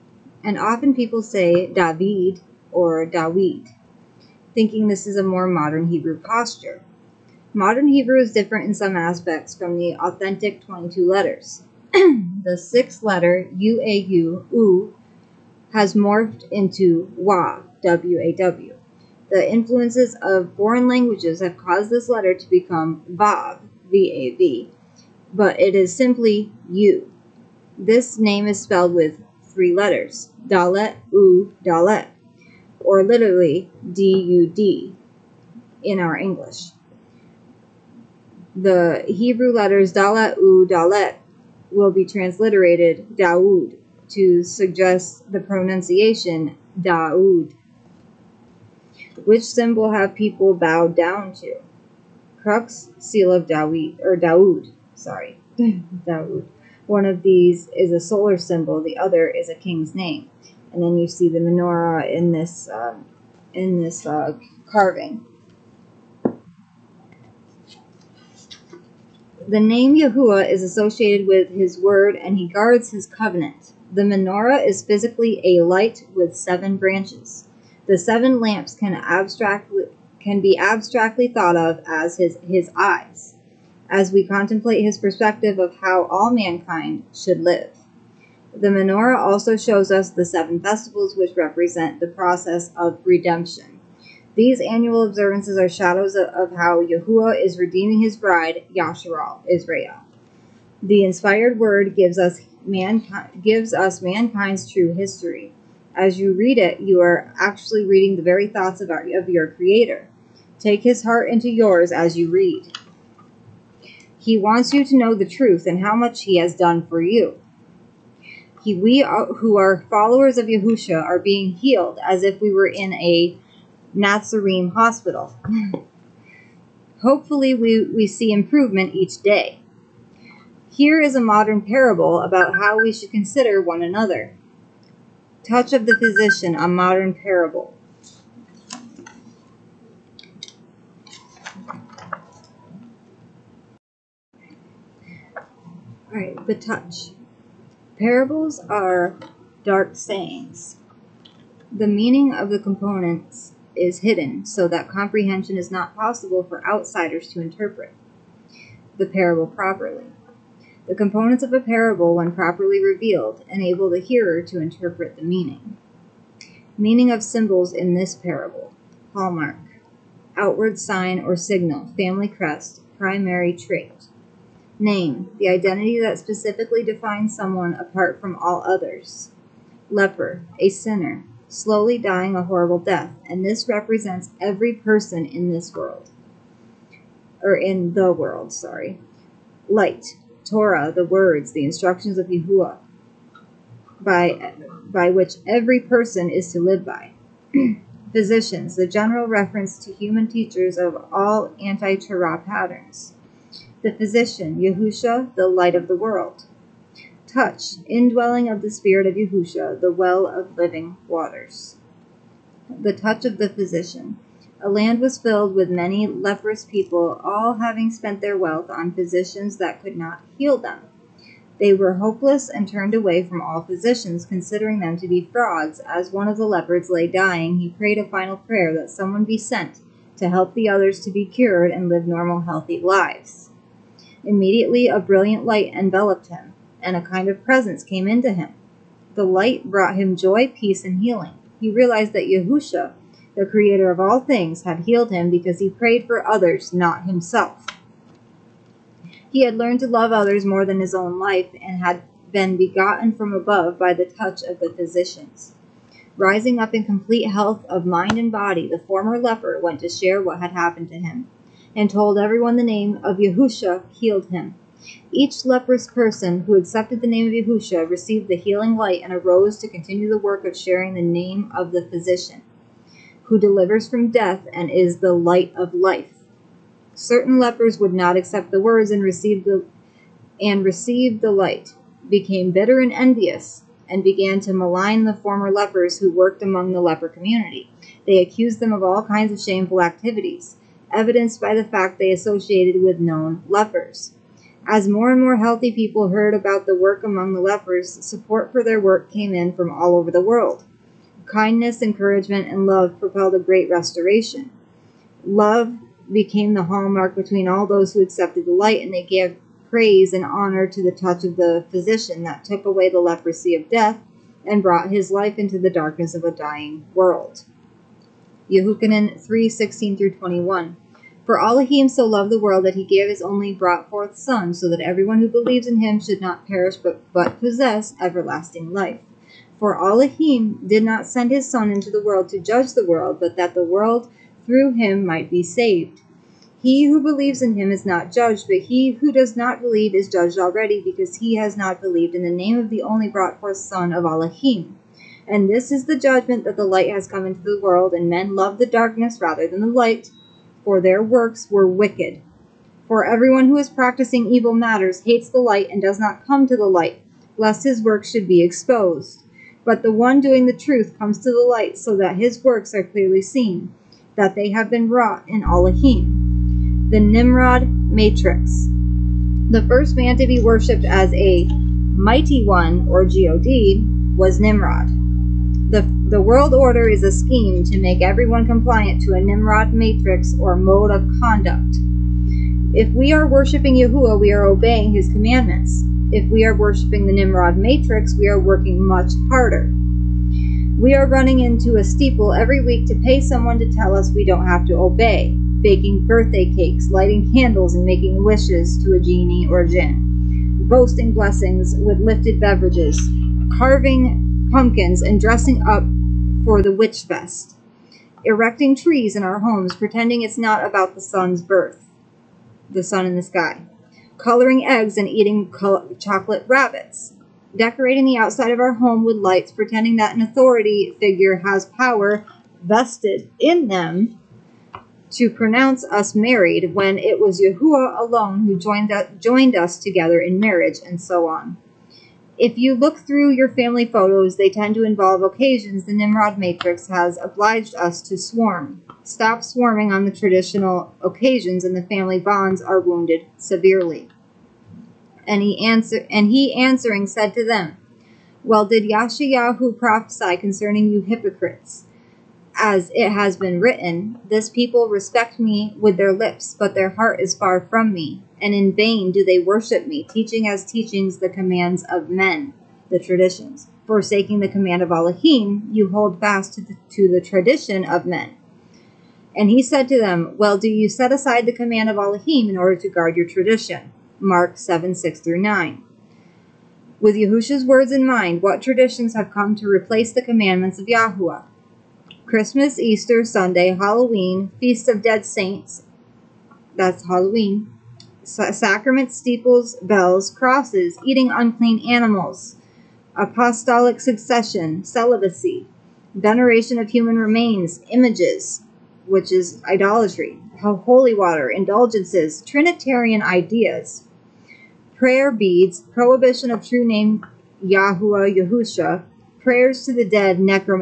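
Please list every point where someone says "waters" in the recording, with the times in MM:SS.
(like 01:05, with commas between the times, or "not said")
03:31, 08:21.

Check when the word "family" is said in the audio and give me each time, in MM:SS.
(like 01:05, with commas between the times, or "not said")
02:51, 07:13, 07:21.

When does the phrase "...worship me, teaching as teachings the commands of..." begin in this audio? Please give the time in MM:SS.
07:39.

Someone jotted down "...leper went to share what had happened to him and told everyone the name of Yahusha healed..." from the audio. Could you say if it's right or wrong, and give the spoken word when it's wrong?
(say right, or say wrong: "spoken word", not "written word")
right.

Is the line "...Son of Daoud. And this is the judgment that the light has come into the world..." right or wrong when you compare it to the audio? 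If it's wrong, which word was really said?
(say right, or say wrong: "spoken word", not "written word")
wrong: "Elohim", not "Daoud".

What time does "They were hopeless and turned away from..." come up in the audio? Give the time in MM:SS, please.
03:41.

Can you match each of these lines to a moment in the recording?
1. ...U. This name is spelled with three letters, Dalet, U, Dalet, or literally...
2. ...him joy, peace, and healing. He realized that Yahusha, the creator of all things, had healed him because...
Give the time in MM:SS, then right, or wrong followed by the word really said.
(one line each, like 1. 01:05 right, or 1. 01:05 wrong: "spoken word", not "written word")
1. 00:26 right
2. 03:59 right.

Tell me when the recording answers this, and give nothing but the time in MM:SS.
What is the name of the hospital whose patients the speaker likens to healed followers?
02:03.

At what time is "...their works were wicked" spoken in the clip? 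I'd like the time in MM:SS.
05:50.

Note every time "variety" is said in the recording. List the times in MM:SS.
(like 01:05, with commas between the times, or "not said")
not said.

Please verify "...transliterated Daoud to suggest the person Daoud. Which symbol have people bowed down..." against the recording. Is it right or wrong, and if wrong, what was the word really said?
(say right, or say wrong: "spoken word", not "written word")
wrong: "pronunciation", not "person".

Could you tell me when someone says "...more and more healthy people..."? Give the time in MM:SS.
04:54.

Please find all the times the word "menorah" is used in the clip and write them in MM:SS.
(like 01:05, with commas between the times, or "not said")
01:01, 01:14, 01:28.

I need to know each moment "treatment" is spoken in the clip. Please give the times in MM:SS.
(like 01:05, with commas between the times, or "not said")
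not said.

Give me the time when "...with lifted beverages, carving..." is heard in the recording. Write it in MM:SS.
06:41.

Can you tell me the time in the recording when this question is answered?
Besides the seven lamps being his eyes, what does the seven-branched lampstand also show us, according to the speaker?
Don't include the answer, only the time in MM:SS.
01:30.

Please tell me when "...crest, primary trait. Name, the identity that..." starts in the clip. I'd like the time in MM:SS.
02:52.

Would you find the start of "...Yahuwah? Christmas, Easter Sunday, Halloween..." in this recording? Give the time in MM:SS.
08:00.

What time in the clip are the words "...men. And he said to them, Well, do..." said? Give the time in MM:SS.
07:48.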